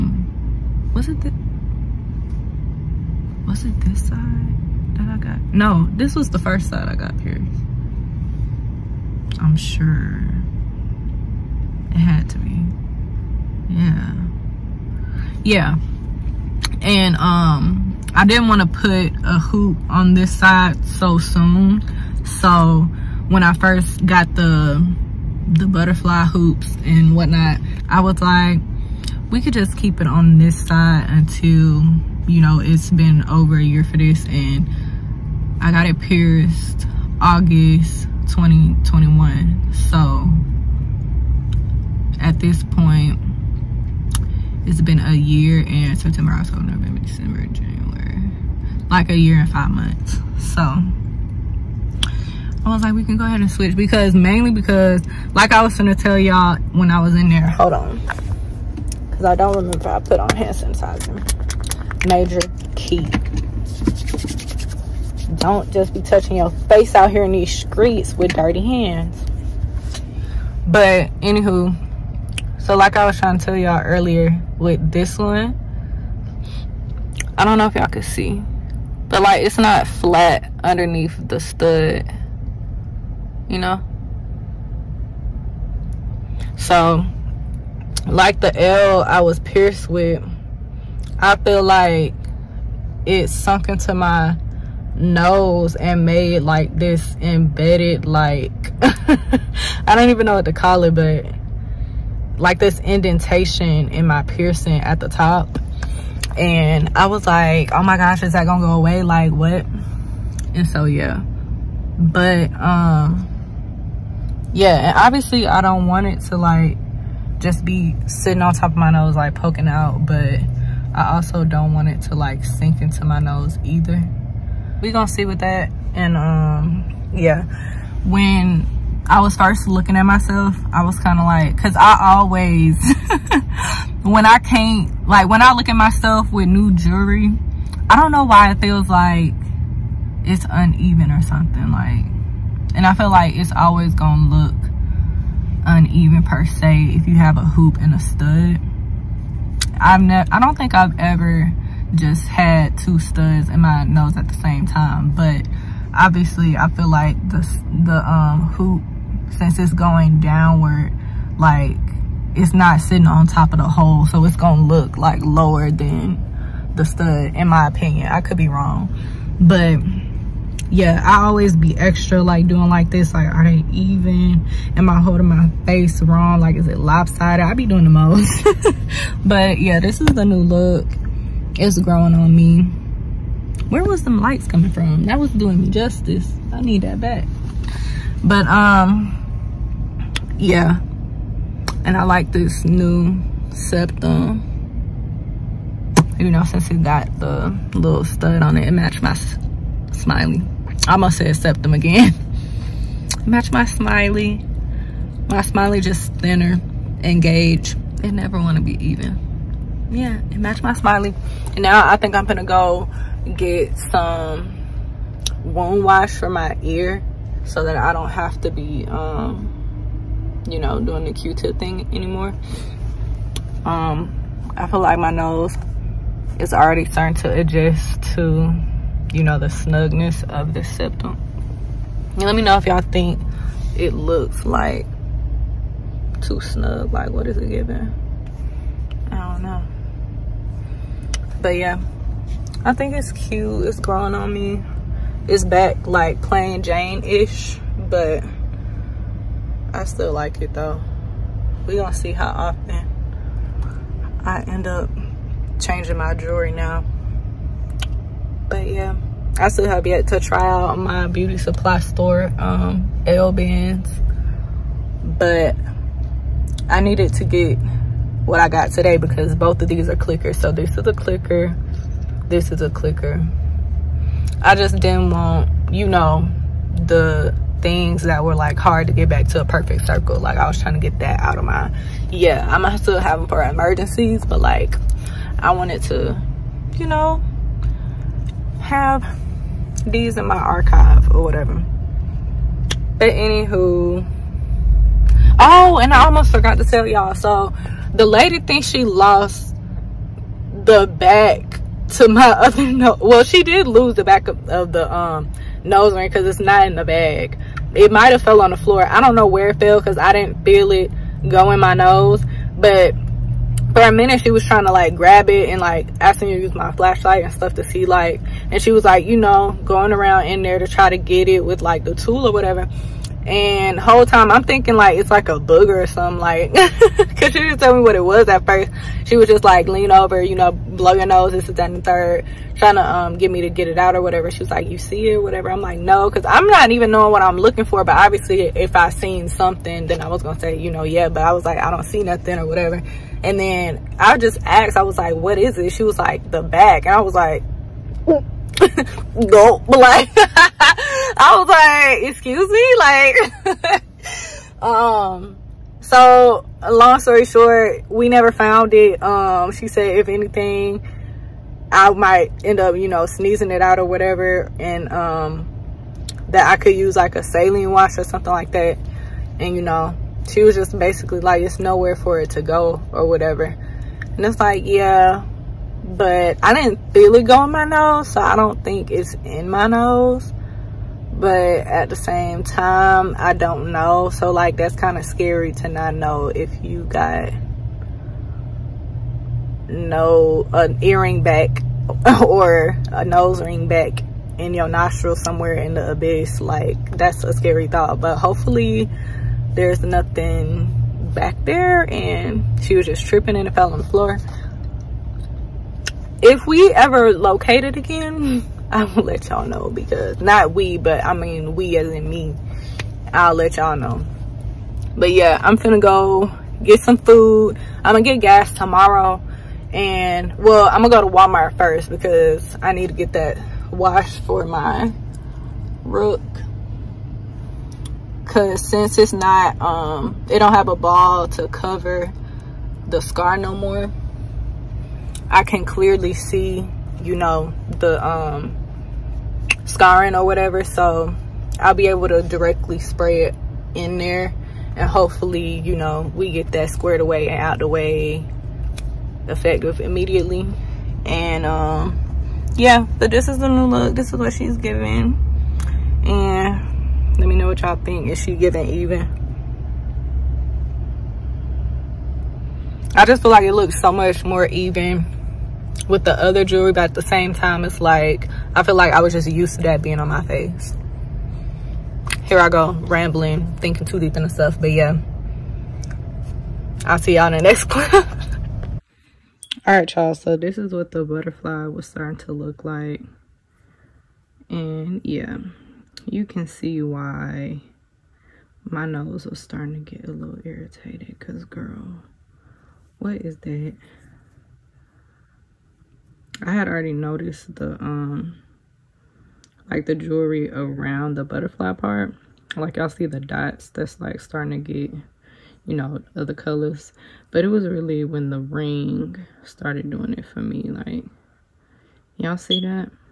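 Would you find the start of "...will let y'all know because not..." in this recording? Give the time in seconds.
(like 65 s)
408 s.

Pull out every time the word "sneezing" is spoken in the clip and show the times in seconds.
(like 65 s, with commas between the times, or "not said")
363 s.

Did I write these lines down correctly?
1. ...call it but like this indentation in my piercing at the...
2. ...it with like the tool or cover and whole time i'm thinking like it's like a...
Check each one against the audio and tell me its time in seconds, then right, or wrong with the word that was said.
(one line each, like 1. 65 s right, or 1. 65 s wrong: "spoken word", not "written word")
1. 100 s right
2. 321 s wrong: "whatever", not "cover".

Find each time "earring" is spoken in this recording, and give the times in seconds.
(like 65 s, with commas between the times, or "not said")
390 s.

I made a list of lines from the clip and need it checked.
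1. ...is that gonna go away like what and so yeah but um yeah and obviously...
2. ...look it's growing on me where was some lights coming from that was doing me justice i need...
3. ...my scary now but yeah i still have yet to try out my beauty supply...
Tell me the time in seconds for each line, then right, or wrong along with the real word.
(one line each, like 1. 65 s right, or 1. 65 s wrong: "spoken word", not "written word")
1. 108 s right
2. 180 s right
3. 255 s wrong: "jewelry", not "scary".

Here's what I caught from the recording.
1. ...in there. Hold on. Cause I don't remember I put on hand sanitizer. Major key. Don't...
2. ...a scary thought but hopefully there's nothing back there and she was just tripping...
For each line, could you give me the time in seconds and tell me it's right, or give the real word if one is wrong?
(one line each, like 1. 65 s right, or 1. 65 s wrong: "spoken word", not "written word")
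1. 57 s right
2. 397 s right.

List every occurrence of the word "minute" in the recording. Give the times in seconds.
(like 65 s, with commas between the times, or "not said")
313 s.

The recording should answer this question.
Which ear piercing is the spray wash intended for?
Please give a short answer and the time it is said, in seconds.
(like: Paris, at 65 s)
Rook, at 425 s.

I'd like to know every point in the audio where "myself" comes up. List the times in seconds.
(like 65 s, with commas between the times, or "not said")
130 s, 135 s.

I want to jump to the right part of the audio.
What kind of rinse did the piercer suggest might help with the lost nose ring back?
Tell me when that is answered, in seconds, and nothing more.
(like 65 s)
367 s.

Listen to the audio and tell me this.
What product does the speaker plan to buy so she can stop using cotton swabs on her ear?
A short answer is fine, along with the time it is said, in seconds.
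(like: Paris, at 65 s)
wound wash, at 215 s.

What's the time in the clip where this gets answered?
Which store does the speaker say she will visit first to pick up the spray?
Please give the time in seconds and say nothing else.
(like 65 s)
421 s.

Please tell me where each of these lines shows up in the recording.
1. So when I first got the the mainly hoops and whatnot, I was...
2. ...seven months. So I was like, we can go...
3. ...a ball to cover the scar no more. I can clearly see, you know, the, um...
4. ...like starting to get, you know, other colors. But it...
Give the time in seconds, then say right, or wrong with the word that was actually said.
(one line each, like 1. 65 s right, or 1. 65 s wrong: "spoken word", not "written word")
1. 22 s wrong: "butterfly", not "mainly"
2. 49 s wrong: "five", not "seven"
3. 430 s right
4. 504 s right.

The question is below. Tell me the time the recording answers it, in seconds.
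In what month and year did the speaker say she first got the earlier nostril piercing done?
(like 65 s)
37 s.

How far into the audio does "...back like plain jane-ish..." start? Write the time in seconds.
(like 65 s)
245 s.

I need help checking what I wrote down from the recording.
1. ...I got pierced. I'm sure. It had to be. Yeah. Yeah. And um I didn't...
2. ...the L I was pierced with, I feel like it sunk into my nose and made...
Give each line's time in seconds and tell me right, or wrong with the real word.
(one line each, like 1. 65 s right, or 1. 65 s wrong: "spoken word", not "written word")
1. 6 s right
2. 88 s right.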